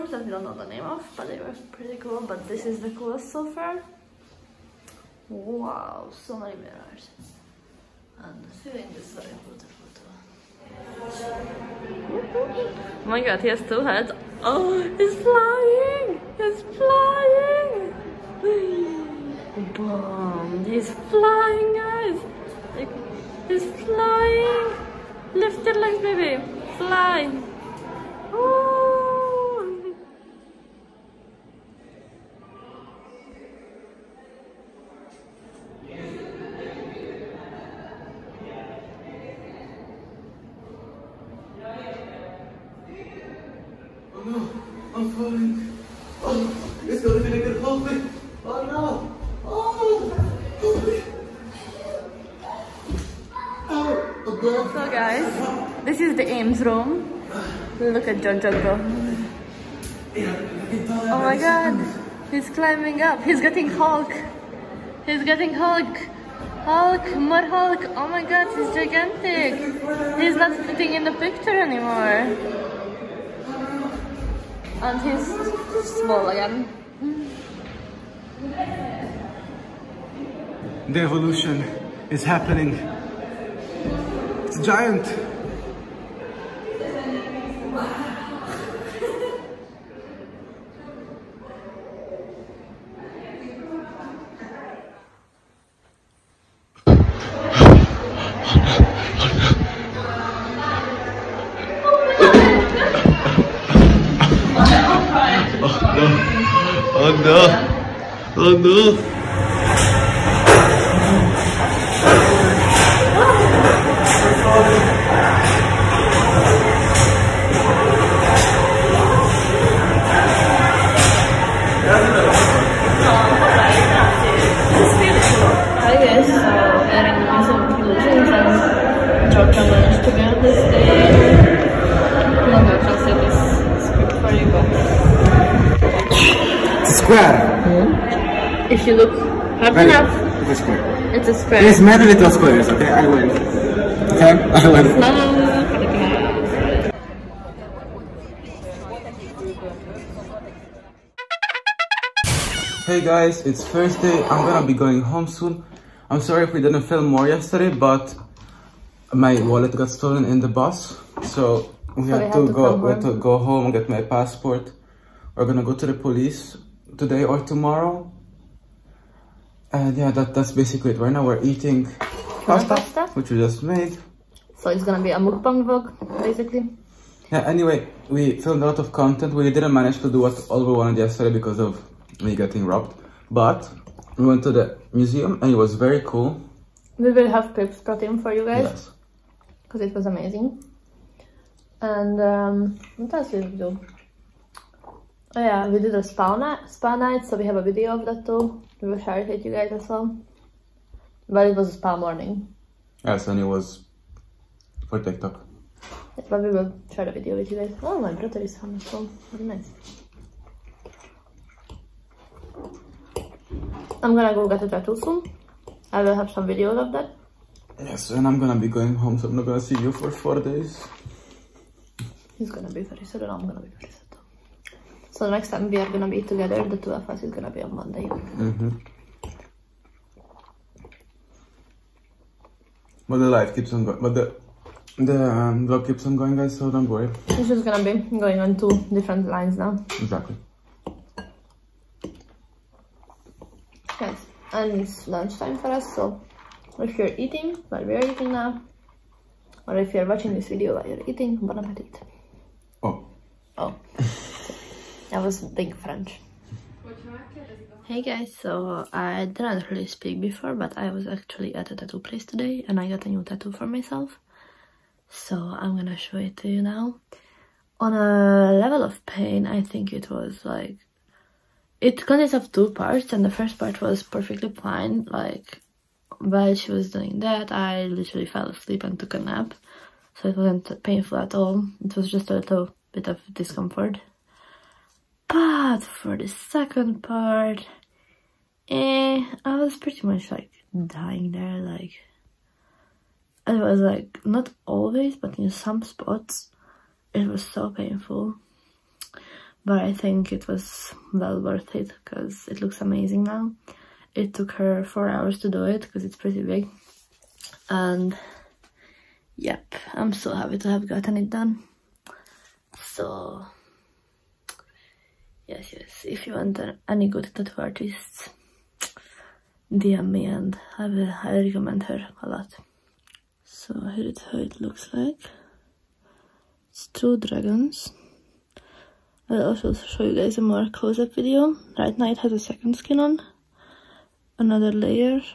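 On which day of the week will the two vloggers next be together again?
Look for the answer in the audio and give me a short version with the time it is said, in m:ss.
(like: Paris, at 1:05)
Monday, at 3:47.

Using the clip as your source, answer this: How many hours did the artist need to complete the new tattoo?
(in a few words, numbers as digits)
4.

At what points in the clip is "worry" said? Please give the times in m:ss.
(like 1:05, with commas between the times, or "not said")
3:56.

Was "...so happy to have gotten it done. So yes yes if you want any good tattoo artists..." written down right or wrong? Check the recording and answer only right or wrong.
right.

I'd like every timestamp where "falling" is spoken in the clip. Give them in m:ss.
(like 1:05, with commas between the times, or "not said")
0:45.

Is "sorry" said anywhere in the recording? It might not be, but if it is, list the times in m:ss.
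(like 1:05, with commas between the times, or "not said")
2:36.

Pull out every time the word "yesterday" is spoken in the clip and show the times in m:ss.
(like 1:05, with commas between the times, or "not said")
2:37, 3:00.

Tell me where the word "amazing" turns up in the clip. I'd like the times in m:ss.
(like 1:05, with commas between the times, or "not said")
3:10, 5:02.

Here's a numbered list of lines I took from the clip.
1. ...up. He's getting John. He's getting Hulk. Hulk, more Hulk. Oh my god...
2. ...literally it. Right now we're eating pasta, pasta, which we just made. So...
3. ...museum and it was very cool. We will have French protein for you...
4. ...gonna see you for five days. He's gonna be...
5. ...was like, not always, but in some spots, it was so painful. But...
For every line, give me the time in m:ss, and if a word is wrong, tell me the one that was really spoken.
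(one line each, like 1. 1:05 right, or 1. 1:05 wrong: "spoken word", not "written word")
1. 1:03 wrong: "Hulk", not "John"
2. 2:50 wrong: "basically", not "literally"
3. 3:04 wrong: "Pips", not "French"
4. 3:39 wrong: "four", not "five"
5. 4:53 right.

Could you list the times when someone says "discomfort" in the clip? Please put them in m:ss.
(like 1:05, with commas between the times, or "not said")
4:43.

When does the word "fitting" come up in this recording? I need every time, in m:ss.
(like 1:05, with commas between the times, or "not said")
1:10.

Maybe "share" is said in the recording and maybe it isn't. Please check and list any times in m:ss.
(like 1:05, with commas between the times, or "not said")
3:18, 3:26.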